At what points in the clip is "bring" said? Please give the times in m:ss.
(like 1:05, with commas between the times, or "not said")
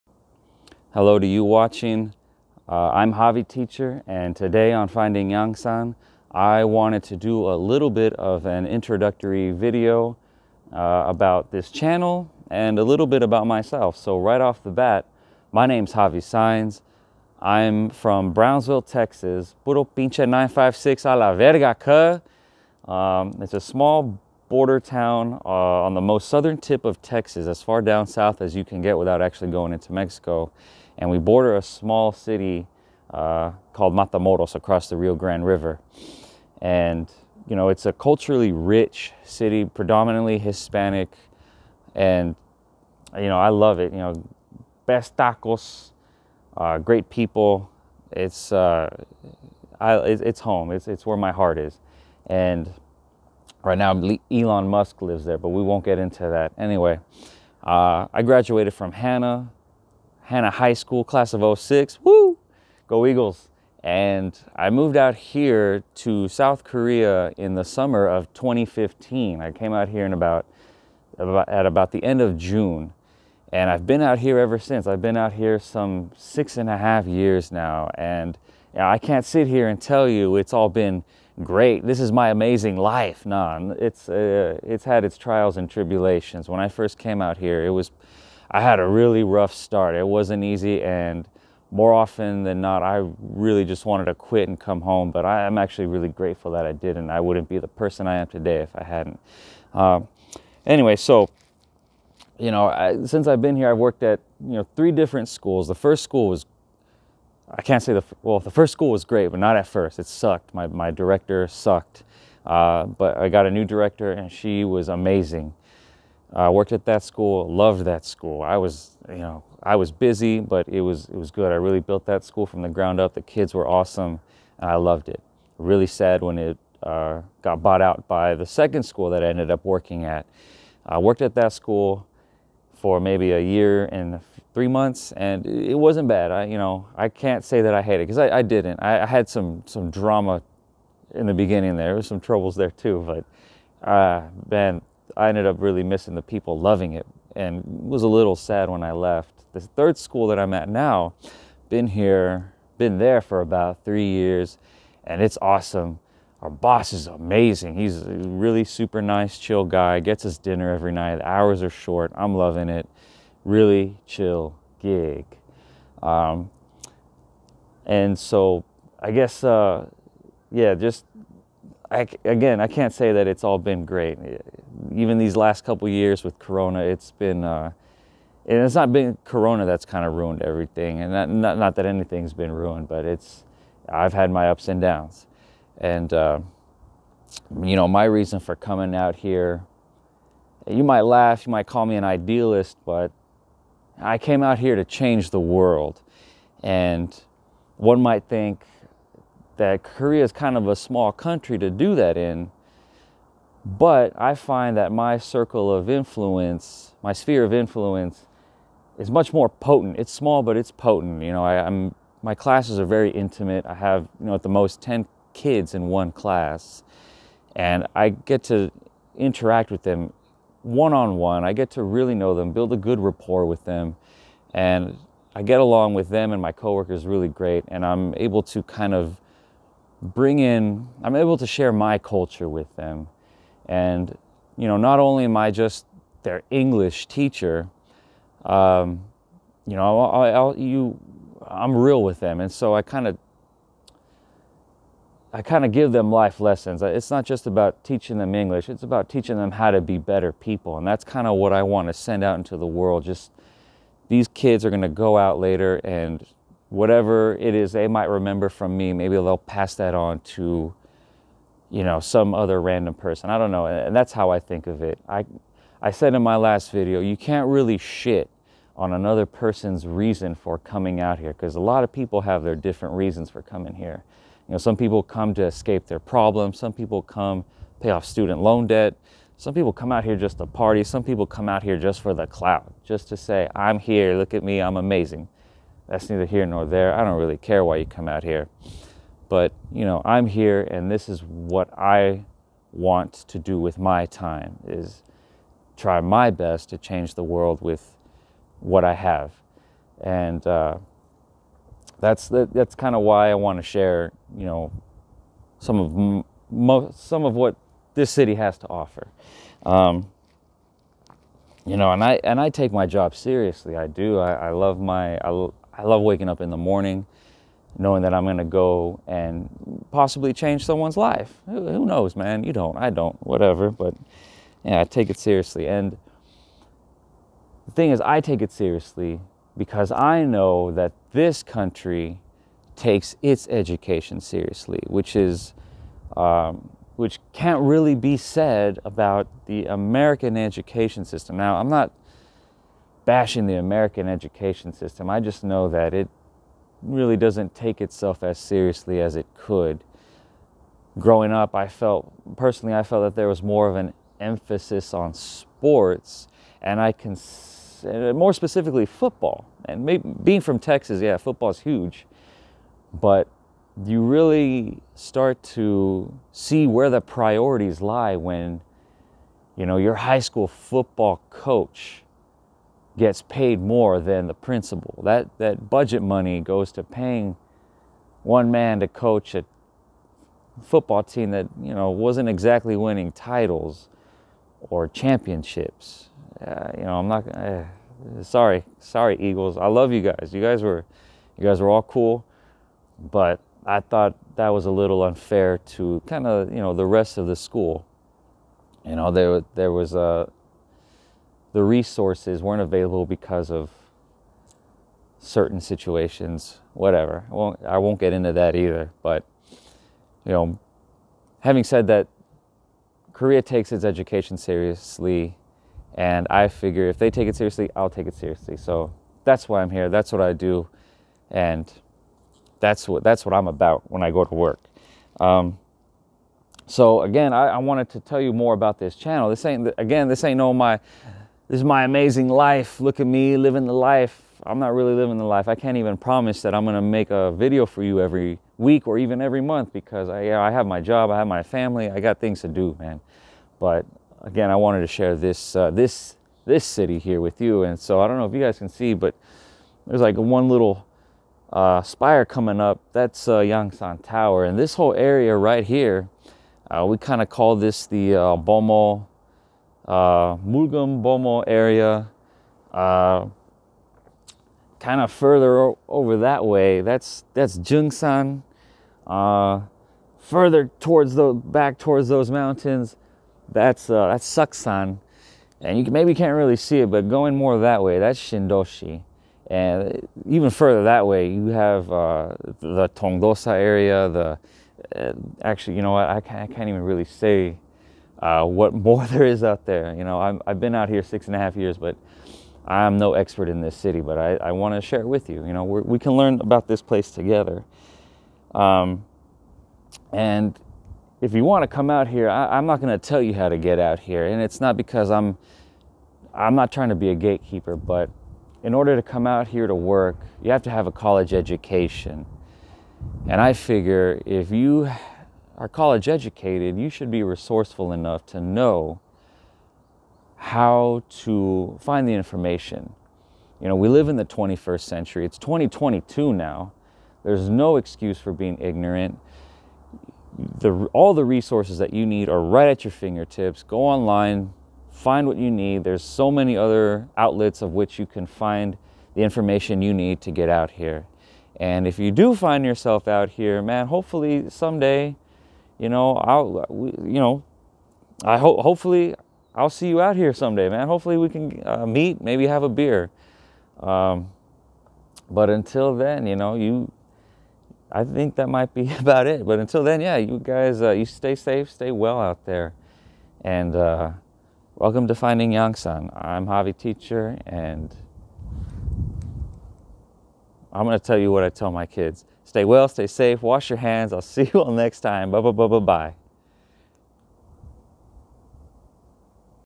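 3:50.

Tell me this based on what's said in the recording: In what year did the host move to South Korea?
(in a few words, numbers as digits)
2015.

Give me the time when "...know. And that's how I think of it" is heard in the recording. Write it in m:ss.
4:23.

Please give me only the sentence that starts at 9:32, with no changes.
Stay well, stay safe, wash your hands.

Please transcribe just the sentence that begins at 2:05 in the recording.
Really sad when it uh, got bought out by the second school that I ended up working at.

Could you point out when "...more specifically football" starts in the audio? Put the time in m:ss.
5:58.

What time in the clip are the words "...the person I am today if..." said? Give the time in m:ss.
1:37.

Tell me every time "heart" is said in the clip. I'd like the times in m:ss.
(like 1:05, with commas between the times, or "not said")
0:51.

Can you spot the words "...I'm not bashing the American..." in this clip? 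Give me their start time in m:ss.
5:41.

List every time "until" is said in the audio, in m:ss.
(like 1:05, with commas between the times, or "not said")
9:15, 9:19.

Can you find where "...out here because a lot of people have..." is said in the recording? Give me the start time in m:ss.
4:31.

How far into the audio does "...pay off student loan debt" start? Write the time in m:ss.
4:37.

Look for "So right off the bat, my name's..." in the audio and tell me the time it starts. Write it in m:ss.
0:13.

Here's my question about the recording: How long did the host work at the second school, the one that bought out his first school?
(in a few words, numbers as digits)
a year and three months.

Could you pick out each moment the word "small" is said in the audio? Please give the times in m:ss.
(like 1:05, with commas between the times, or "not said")
0:23, 0:31, 3:20, 3:30.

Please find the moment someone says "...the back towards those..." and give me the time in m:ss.
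7:51.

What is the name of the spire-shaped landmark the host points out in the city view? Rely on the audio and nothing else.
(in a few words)
Yangsan Tower.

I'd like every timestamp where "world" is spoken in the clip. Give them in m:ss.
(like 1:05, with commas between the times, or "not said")
3:15, 4:12, 4:57.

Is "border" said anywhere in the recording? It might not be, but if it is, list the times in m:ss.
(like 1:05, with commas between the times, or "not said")
0:24, 0:31.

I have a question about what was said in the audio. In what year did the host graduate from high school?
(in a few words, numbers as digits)
2006.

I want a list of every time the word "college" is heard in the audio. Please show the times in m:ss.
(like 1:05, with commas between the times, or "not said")
8:30, 8:35.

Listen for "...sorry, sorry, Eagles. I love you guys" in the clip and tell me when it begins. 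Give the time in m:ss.
6:28.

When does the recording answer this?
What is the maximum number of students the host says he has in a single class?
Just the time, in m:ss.
3:34.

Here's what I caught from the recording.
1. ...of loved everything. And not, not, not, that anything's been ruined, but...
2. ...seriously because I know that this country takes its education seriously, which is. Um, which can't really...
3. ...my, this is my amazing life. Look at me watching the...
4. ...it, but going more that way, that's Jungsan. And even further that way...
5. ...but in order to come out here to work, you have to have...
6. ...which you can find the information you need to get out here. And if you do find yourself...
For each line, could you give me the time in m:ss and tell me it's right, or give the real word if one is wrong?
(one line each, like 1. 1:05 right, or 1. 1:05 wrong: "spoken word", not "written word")
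1. 3:00 wrong: "ruined", not "loved"
2. 5:28 right
3. 7:10 wrong: "living", not "watching"
4. 7:56 wrong: "Shindoshi", not "Jungsan"
5. 8:27 right
6. 8:57 right.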